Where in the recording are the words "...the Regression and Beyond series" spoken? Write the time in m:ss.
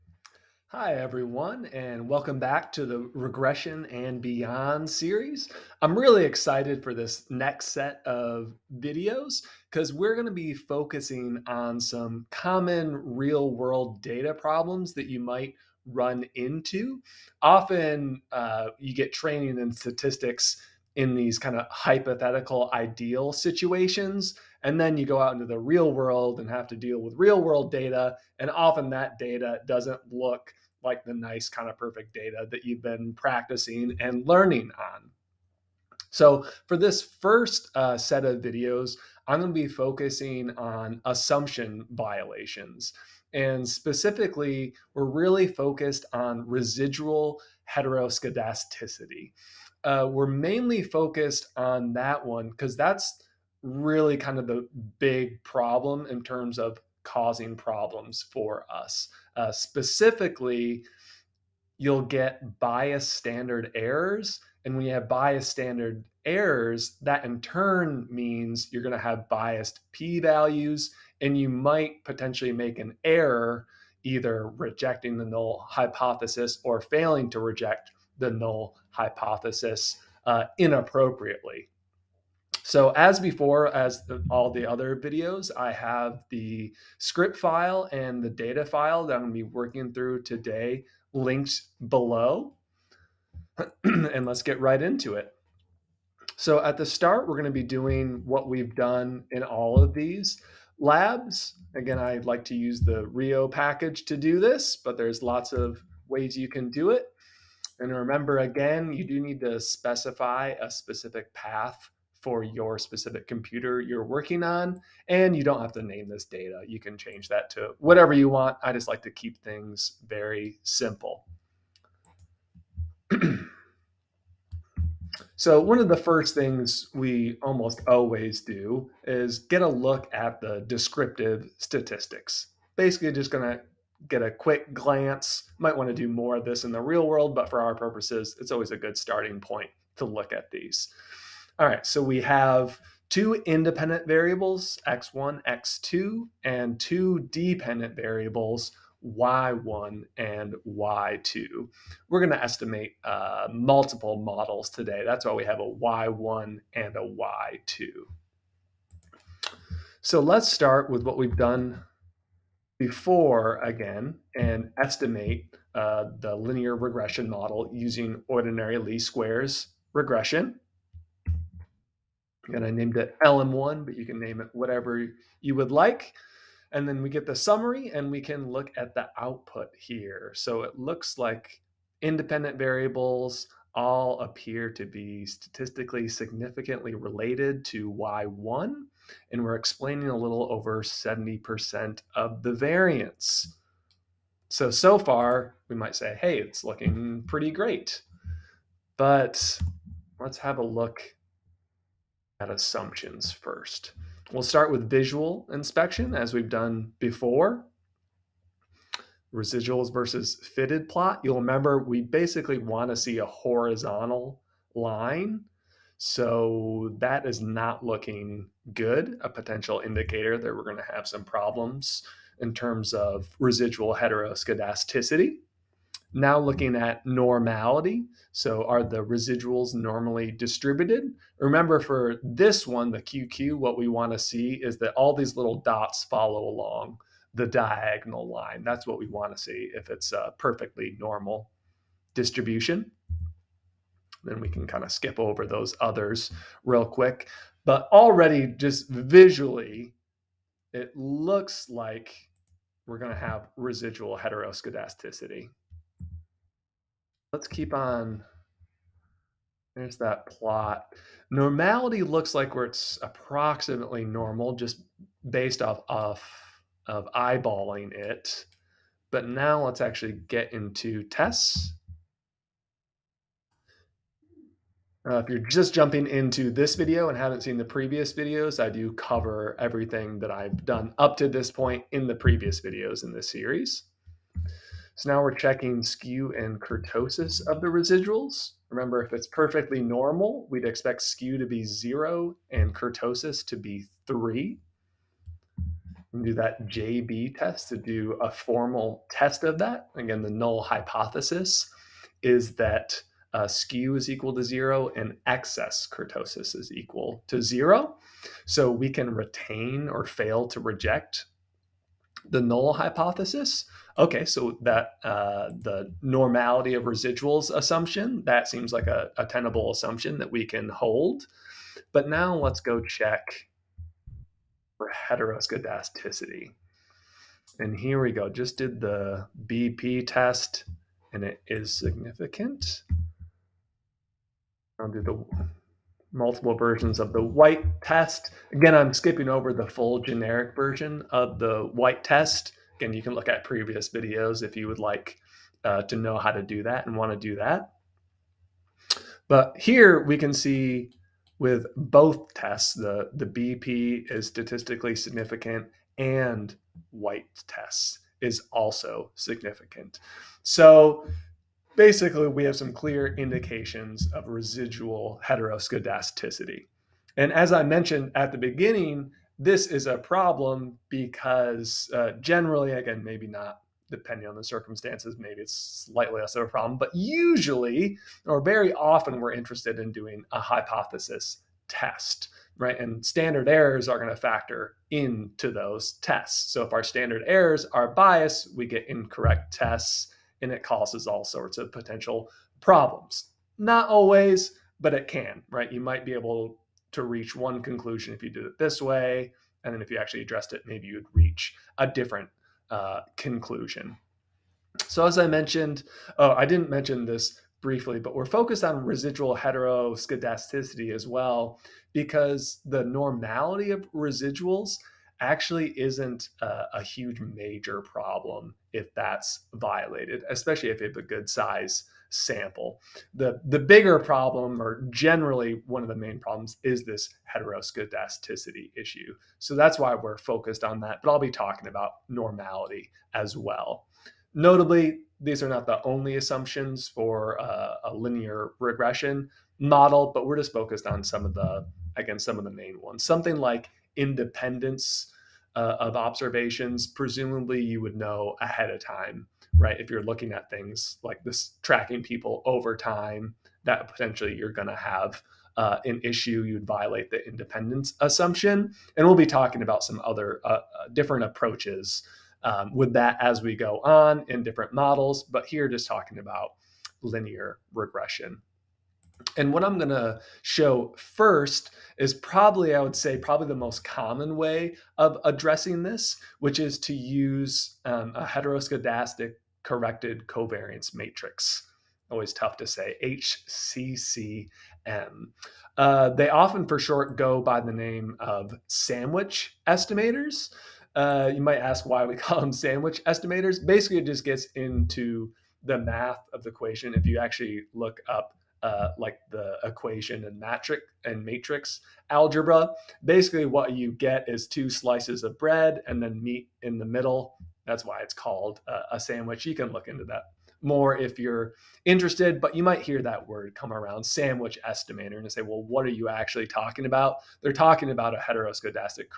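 0:02.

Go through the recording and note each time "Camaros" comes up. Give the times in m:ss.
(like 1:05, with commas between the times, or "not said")
not said.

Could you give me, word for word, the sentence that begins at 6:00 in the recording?
So basically, we have some clear indications of residual heteroscedasticity.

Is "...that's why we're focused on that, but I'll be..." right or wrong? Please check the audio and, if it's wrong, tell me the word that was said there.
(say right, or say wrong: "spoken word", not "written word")
right.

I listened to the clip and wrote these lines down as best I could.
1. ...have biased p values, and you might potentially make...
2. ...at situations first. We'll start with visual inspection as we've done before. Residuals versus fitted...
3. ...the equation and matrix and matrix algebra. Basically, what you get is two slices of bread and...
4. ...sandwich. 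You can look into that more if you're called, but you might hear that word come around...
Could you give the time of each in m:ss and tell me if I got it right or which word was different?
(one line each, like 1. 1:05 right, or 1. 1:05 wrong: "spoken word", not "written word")
1. 1:08 right
2. 3:22 wrong: "assumptions", not "situations"
3. 8:19 right
4. 8:28 wrong: "interested", not "called".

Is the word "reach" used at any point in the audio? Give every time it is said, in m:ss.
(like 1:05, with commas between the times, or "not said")
6:37, 6:41.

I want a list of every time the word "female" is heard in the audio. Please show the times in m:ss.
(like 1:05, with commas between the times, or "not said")
not said.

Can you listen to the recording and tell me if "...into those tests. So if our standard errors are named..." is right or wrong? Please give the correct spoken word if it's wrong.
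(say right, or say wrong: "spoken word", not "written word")
wrong: "biased", not "named".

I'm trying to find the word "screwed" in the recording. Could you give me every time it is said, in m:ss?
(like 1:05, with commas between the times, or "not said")
not said.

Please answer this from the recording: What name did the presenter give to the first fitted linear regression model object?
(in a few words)
LM1.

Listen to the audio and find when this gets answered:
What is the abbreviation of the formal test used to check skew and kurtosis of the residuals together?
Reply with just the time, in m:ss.
4:56.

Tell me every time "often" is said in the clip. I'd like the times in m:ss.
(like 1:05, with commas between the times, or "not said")
0:17, 0:28, 6:18, 8:06.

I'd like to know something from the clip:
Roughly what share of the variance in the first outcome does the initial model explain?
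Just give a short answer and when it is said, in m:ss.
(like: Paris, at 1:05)
a little over 70%, at 3:10.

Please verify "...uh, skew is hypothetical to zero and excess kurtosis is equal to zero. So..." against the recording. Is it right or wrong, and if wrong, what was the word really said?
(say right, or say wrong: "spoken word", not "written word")
wrong: "equal", not "hypothetical".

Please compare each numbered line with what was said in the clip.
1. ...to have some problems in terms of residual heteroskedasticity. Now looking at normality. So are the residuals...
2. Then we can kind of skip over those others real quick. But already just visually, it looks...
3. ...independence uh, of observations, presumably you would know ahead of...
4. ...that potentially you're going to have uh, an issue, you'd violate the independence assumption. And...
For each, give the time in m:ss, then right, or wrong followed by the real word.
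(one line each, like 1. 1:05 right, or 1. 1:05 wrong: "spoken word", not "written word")
1. 3:40 right
2. 4:04 right
3. 7:23 right
4. 7:33 right.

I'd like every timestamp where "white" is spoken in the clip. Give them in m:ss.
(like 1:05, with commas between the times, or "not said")
5:37, 5:41, 5:56.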